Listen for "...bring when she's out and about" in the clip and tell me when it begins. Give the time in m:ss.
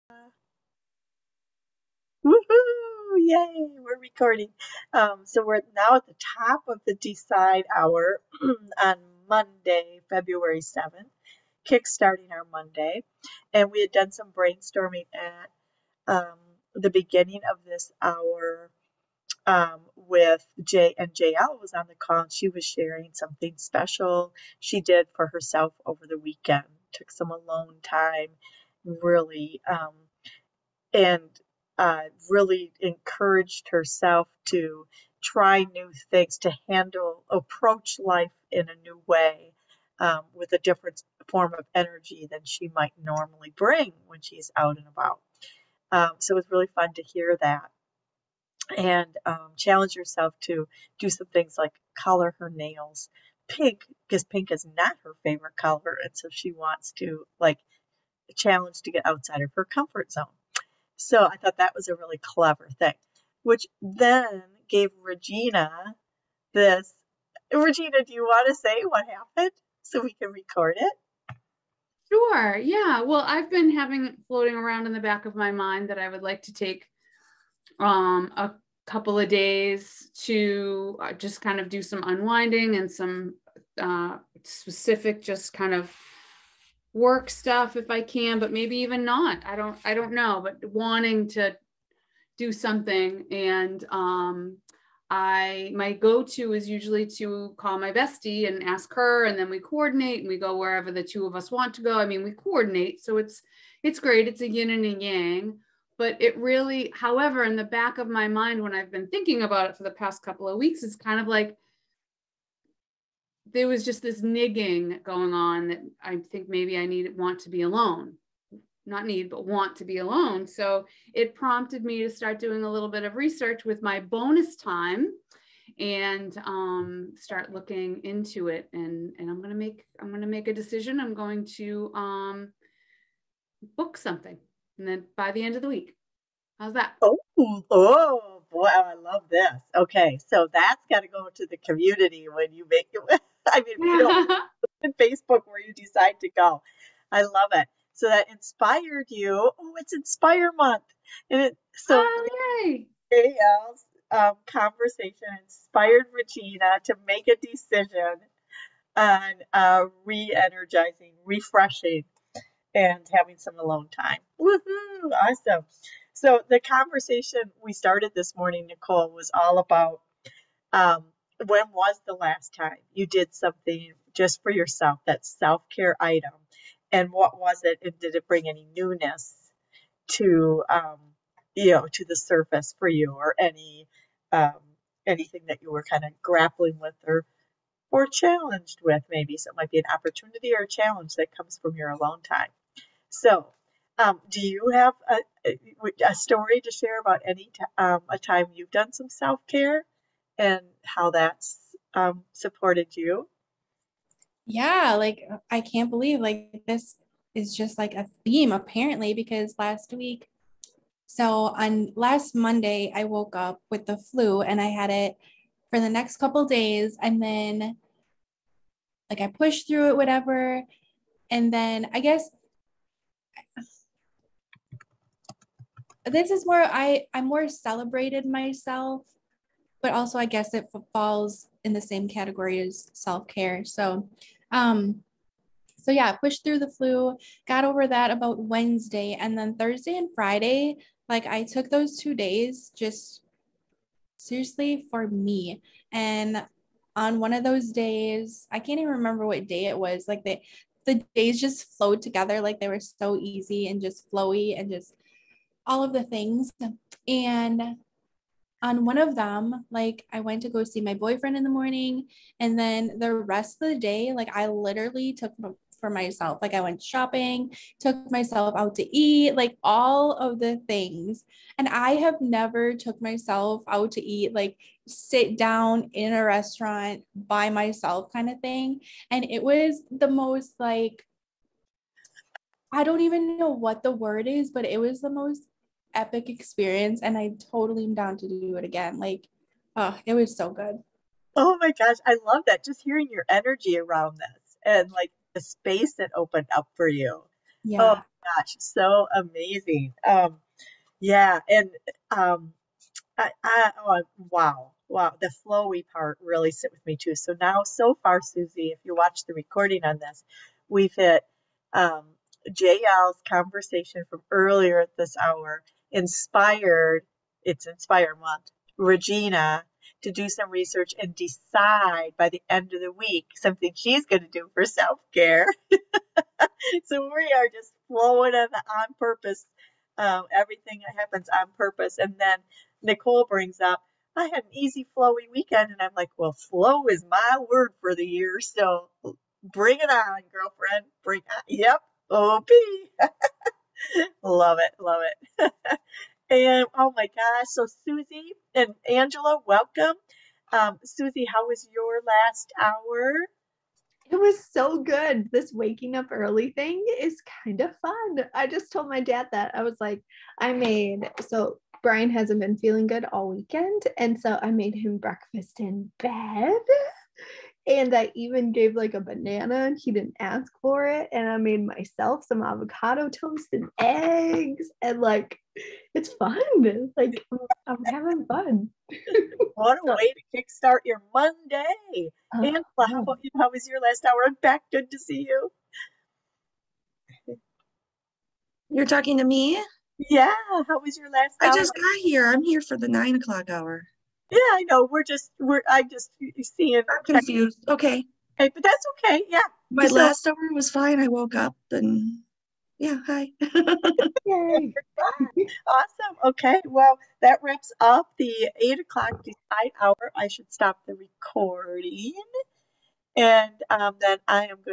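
0:43.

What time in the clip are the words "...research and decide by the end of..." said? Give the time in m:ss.
5:20.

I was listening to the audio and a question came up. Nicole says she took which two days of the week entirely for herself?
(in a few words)
Thursday and Friday.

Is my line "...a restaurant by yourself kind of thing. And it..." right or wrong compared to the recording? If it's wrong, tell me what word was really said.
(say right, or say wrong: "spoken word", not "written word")
wrong: "myself", not "yourself".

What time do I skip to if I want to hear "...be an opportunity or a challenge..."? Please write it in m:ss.
3:09.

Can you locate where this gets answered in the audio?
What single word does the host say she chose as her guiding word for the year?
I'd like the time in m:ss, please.
5:36.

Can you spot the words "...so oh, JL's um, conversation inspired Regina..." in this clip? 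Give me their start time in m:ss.
2:31.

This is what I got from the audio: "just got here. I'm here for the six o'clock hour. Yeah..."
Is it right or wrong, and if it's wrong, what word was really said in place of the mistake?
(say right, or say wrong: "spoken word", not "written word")
wrong: "nine", not "six".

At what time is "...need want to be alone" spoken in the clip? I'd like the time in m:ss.
1:56.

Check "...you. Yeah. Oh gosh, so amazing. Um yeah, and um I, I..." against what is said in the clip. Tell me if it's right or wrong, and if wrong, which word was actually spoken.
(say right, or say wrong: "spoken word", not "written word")
right.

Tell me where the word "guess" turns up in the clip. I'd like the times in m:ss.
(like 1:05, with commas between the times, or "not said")
3:42, 3:50.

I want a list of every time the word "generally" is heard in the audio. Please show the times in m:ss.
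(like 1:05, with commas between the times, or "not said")
not said.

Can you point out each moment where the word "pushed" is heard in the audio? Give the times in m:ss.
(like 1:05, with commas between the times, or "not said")
3:39, 3:56.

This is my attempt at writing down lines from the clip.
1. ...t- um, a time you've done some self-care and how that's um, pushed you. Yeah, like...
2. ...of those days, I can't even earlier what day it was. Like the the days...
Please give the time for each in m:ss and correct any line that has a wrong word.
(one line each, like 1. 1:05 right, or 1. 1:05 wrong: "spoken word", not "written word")
1. 3:17 wrong: "supported", not "pushed"
2. 4:07 wrong: "remember", not "earlier".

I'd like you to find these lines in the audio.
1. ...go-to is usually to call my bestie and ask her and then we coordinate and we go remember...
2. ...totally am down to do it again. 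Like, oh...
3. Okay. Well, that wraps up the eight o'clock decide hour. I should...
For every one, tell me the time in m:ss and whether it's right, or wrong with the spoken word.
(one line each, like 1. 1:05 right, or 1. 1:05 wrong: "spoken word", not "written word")
1. 1:35 wrong: "wherever", not "remember"
2. 4:47 right
3. 6:46 right.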